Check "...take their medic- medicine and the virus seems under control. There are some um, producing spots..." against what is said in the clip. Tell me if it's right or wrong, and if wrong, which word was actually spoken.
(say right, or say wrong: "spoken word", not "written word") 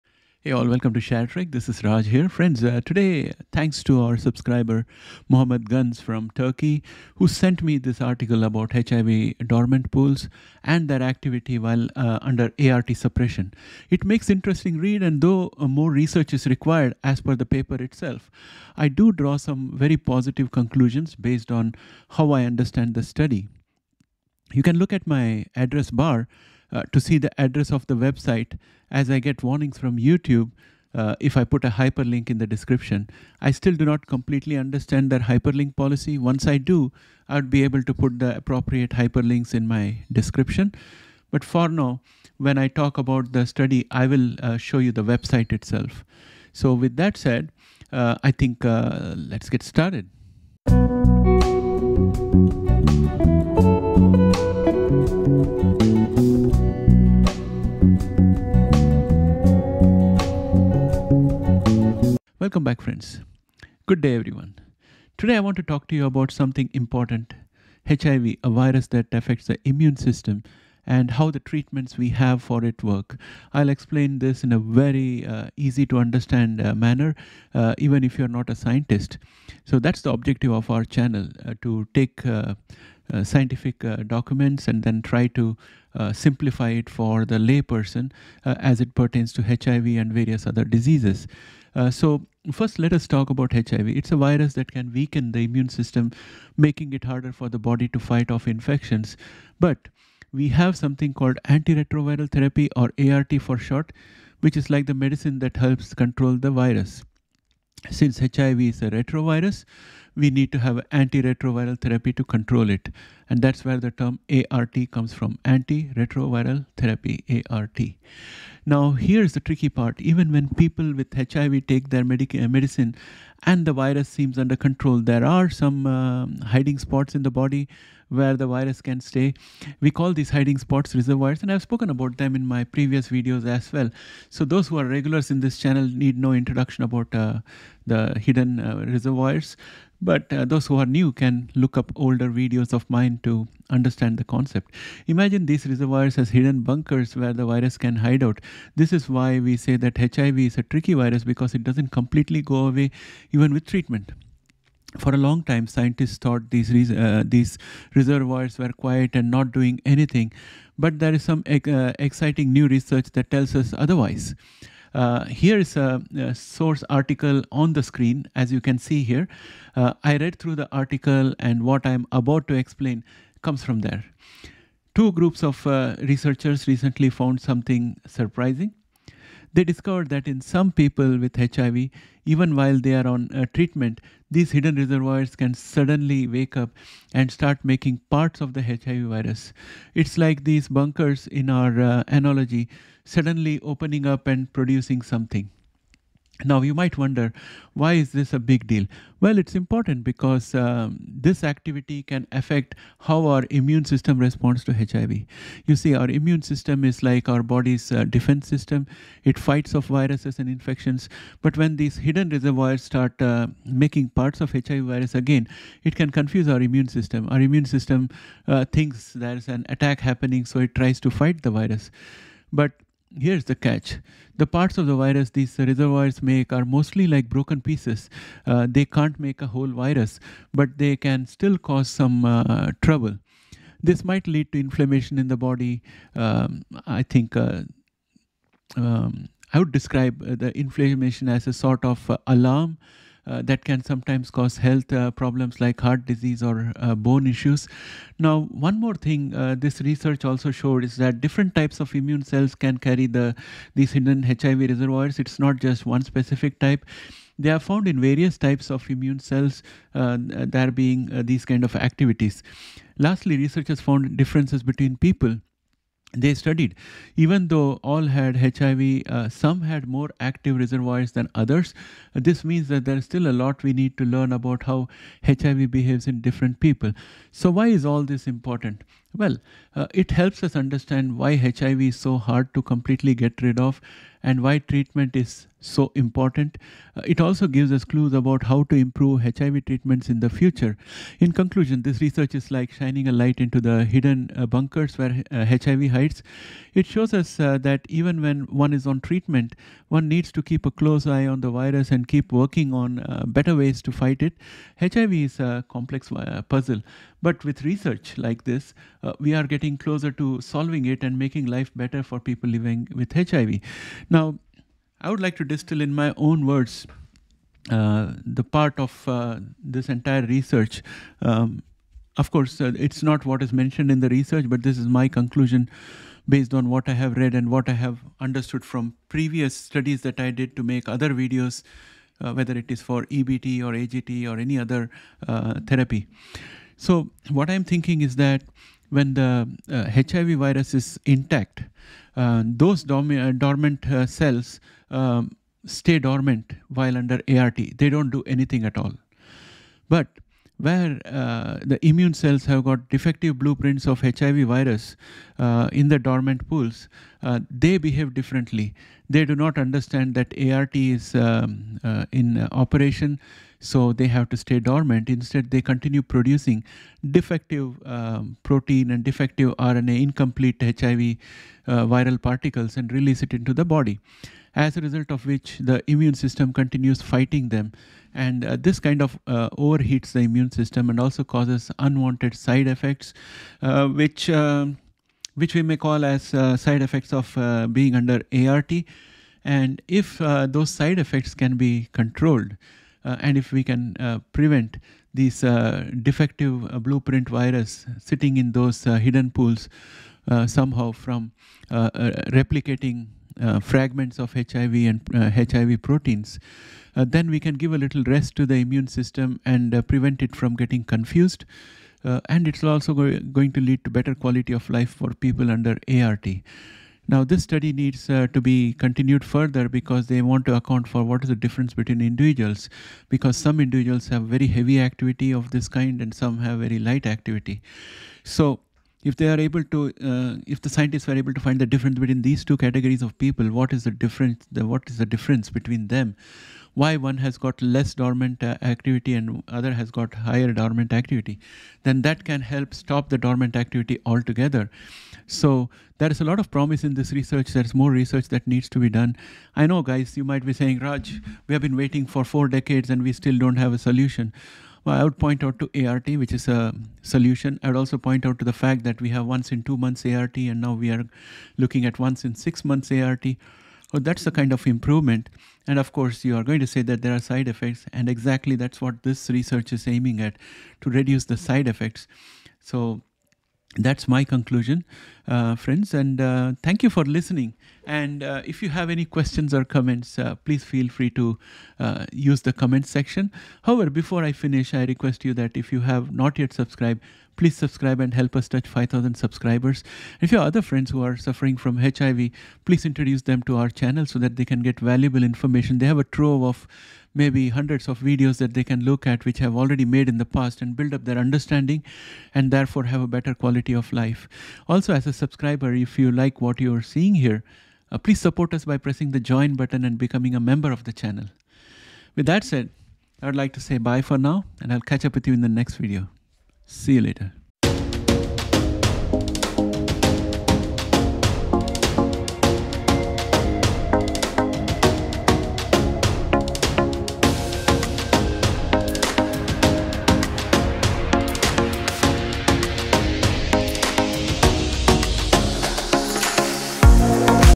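wrong: "hiding", not "producing".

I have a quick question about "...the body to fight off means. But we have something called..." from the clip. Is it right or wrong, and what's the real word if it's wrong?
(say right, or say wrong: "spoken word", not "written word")
wrong: "infections", not "means".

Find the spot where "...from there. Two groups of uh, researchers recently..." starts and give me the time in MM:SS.
02:53.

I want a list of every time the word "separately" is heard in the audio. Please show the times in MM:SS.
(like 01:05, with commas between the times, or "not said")
not said.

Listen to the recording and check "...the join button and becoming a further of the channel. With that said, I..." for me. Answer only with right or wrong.
wrong.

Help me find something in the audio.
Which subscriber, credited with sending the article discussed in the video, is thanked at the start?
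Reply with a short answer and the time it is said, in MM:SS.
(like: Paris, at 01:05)
Muhammed Gunes, at 00:05.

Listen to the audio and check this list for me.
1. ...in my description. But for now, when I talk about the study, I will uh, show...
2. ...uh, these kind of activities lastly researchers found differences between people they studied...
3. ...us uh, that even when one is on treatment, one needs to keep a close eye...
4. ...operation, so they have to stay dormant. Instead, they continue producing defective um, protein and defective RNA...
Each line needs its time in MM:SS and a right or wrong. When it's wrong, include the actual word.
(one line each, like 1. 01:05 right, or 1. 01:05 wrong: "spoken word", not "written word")
1. 00:39 right
2. 04:21 right
3. 04:57 right
4. 06:02 right.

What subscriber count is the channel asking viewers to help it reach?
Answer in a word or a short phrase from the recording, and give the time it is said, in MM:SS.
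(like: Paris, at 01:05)
5,000, at 08:08.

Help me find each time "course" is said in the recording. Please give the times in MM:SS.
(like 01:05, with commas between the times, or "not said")
05:22, 07:45.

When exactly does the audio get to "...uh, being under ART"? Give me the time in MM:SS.
06:27.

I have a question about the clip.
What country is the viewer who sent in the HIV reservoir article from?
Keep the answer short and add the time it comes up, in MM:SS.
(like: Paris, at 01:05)
Turkey, at 00:06.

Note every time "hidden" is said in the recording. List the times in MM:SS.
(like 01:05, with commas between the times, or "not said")
02:18, 02:26, 03:04, 03:31, 04:13, 04:53, 06:38.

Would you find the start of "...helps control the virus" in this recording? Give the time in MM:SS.
01:45.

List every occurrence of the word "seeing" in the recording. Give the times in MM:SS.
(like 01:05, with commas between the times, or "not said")
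08:26.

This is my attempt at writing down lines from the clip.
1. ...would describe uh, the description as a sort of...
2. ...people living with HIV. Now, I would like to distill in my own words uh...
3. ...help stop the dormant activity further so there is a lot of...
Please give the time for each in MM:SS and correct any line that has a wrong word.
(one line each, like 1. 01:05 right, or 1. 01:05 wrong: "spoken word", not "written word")
1. 03:59 wrong: "inflammation", not "description"
2. 05:12 right
3. 07:22 wrong: "altogether", not "further".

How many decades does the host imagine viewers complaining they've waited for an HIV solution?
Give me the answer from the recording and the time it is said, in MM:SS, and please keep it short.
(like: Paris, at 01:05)
4, at 07:32.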